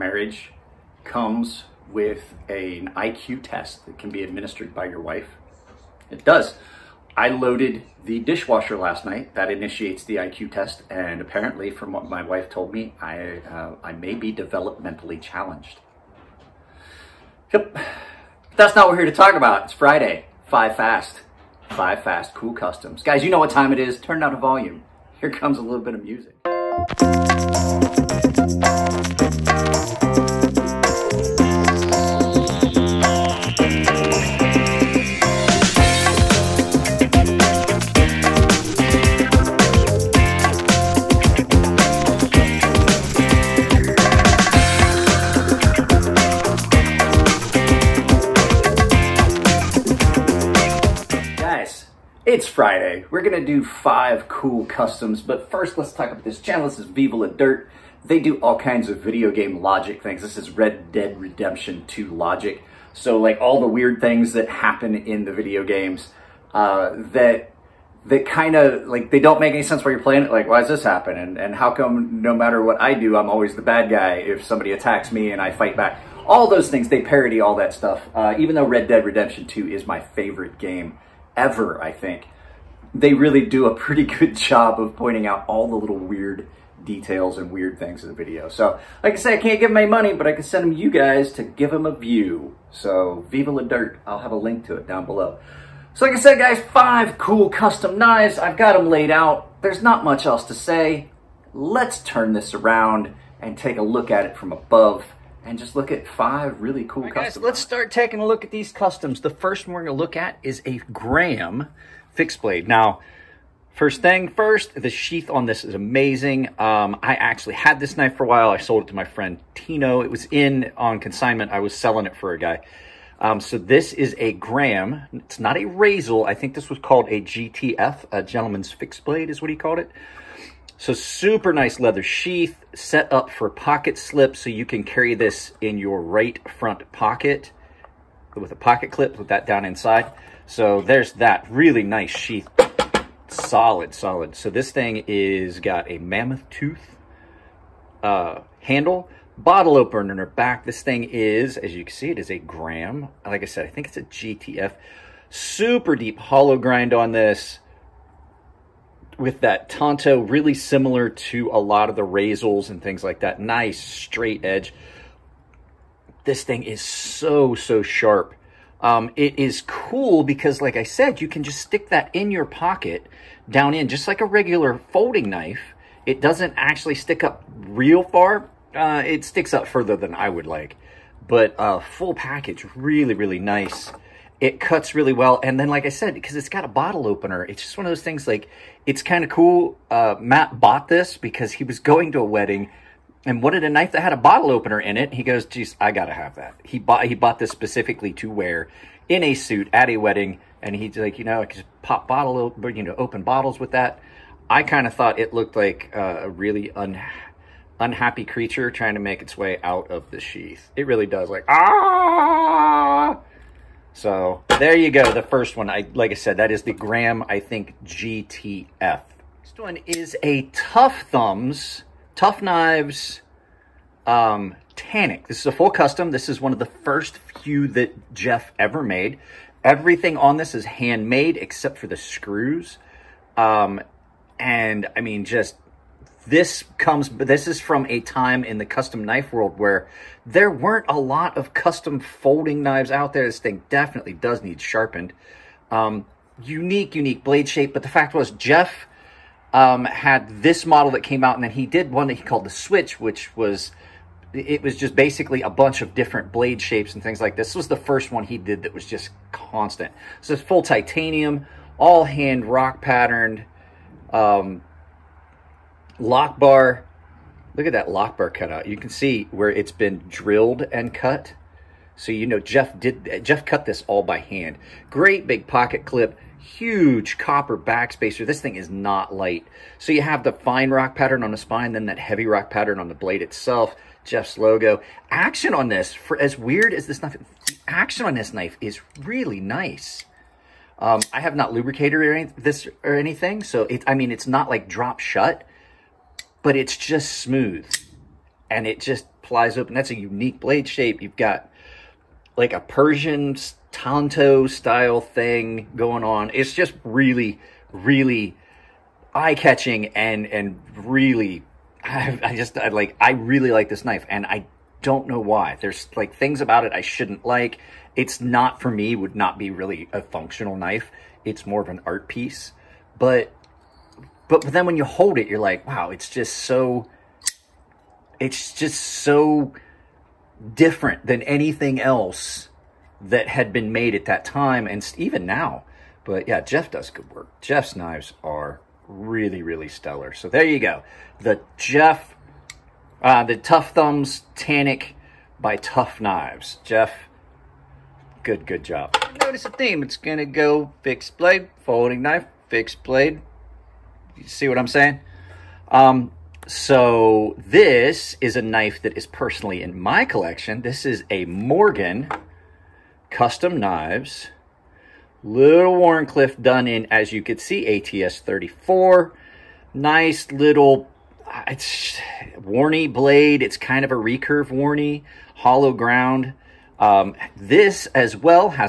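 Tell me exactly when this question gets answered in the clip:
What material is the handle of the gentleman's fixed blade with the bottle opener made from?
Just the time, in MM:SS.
02:25.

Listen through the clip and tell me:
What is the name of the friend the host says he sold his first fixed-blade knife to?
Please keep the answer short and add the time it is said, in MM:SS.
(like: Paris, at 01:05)
Tino, at 01:59.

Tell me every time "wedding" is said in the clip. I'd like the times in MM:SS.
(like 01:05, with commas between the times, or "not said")
03:12, 03:19.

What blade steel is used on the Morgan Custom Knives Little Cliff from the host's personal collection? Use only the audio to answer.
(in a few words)
ATS 34.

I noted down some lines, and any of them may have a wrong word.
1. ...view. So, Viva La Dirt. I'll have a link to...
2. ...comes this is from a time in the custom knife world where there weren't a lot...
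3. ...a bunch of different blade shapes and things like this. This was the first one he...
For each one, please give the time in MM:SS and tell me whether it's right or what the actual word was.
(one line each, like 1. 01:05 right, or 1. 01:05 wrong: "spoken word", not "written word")
1. 01:31 right
2. 03:56 right
3. 04:15 right.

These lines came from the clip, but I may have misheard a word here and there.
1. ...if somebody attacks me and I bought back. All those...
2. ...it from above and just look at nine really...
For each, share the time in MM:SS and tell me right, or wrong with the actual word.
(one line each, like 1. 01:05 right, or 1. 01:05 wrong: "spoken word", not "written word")
1. 01:14 wrong: "fight", not "bought"
2. 01:44 wrong: "five", not "nine".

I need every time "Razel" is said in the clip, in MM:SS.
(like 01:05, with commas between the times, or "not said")
02:05, 02:42.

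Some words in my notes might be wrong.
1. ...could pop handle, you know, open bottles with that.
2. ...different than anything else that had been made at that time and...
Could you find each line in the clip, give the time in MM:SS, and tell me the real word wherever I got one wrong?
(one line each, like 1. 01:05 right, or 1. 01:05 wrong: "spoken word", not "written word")
1. 03:21 wrong: "bottle", not "handle"
2. 05:30 right.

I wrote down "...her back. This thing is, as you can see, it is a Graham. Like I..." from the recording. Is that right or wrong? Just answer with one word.
right.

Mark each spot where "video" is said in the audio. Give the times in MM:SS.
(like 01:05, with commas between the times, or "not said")
00:58, 01:05, 01:28.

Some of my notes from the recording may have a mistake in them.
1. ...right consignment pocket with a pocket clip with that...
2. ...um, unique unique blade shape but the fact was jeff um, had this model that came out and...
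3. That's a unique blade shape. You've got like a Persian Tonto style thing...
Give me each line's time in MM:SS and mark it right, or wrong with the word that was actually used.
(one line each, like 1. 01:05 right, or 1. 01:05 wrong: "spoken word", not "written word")
1. 02:16 wrong: "front", not "consignment"
2. 04:05 right
3. 04:59 right.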